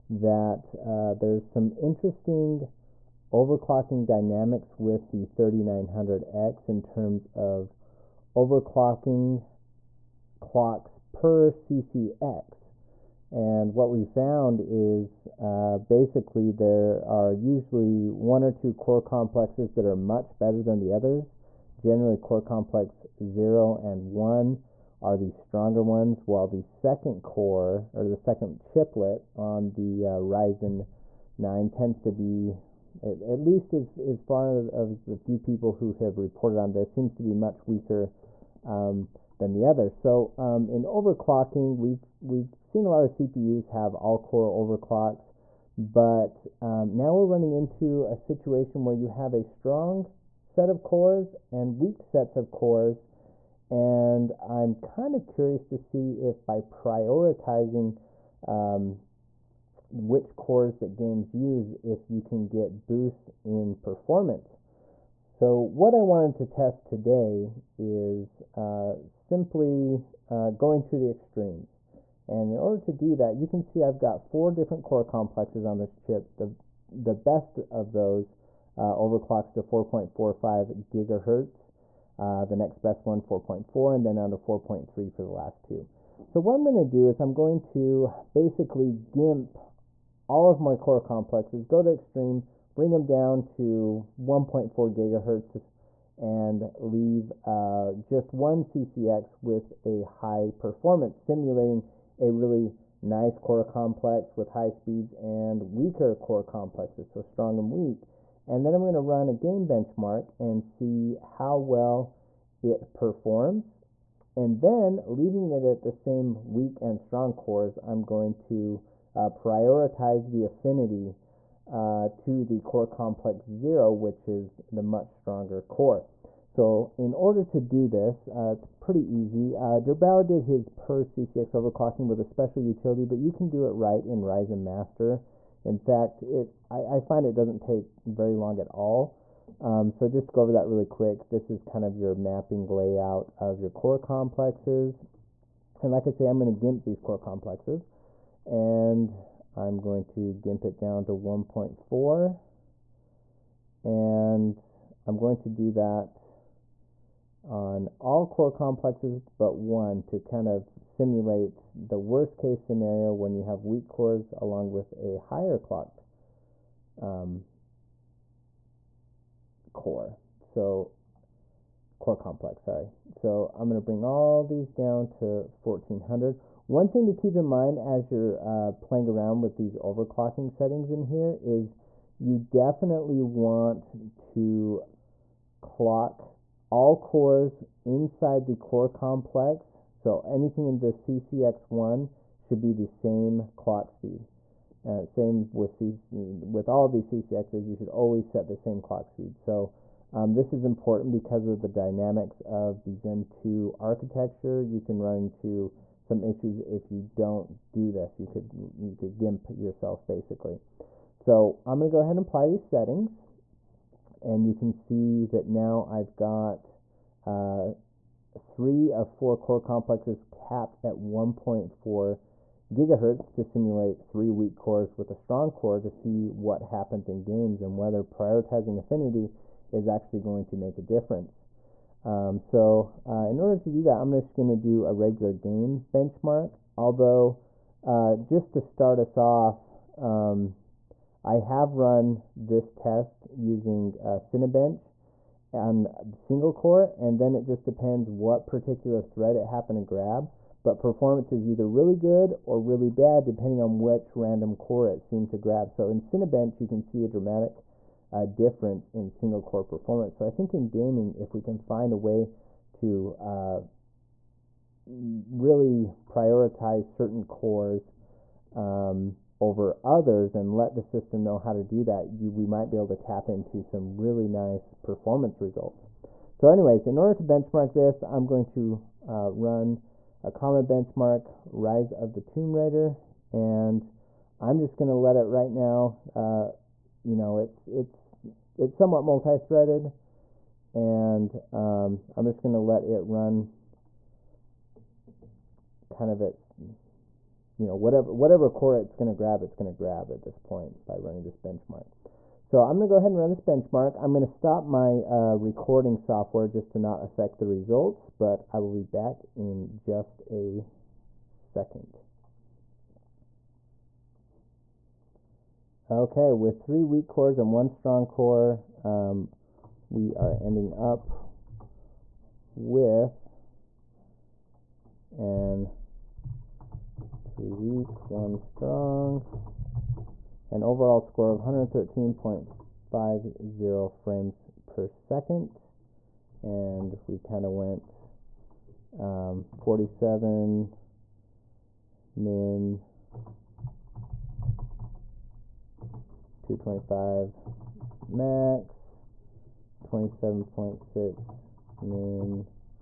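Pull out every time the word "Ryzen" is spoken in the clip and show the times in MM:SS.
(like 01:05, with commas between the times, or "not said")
00:30, 02:14.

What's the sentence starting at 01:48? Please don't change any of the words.
And then I'm going to run a game benchmark and see how well it performs.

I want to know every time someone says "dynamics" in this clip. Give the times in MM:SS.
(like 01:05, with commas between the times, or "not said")
00:04, 03:21.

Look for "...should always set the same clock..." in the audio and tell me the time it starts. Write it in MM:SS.
03:17.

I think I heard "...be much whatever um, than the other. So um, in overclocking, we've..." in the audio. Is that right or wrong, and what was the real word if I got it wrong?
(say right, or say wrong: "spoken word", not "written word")
wrong: "weaker", not "whatever".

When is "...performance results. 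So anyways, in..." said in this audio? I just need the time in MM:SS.
04:34.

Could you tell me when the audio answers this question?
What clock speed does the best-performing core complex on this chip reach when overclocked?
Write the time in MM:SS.
01:19.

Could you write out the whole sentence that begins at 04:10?
But performance is either really good or really bad depending on which random core it seemed to grab.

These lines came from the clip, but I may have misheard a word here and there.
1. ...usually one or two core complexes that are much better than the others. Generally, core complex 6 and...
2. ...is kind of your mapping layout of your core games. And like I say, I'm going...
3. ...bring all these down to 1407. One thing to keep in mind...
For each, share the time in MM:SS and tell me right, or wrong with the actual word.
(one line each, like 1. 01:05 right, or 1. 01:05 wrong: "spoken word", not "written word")
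1. 00:17 wrong: "0", not "6"
2. 02:21 wrong: "complexes", not "games"
3. 02:53 wrong: "1400", not "1407".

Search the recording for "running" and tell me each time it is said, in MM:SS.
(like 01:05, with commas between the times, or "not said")
00:47, 05:00.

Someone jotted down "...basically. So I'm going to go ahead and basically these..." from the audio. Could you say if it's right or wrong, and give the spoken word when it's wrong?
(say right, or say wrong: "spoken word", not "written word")
wrong: "apply", not "basically".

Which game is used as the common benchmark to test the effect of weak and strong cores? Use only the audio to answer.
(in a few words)
Rise of the Tomb Raider.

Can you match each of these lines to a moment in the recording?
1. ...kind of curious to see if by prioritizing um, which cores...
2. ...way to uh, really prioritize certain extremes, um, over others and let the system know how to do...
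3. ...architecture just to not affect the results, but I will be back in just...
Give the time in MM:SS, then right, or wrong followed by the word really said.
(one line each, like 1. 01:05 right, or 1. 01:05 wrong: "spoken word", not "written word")
1. 00:54 right
2. 04:21 wrong: "cores", not "extremes"
3. 05:05 wrong: "software", not "architecture".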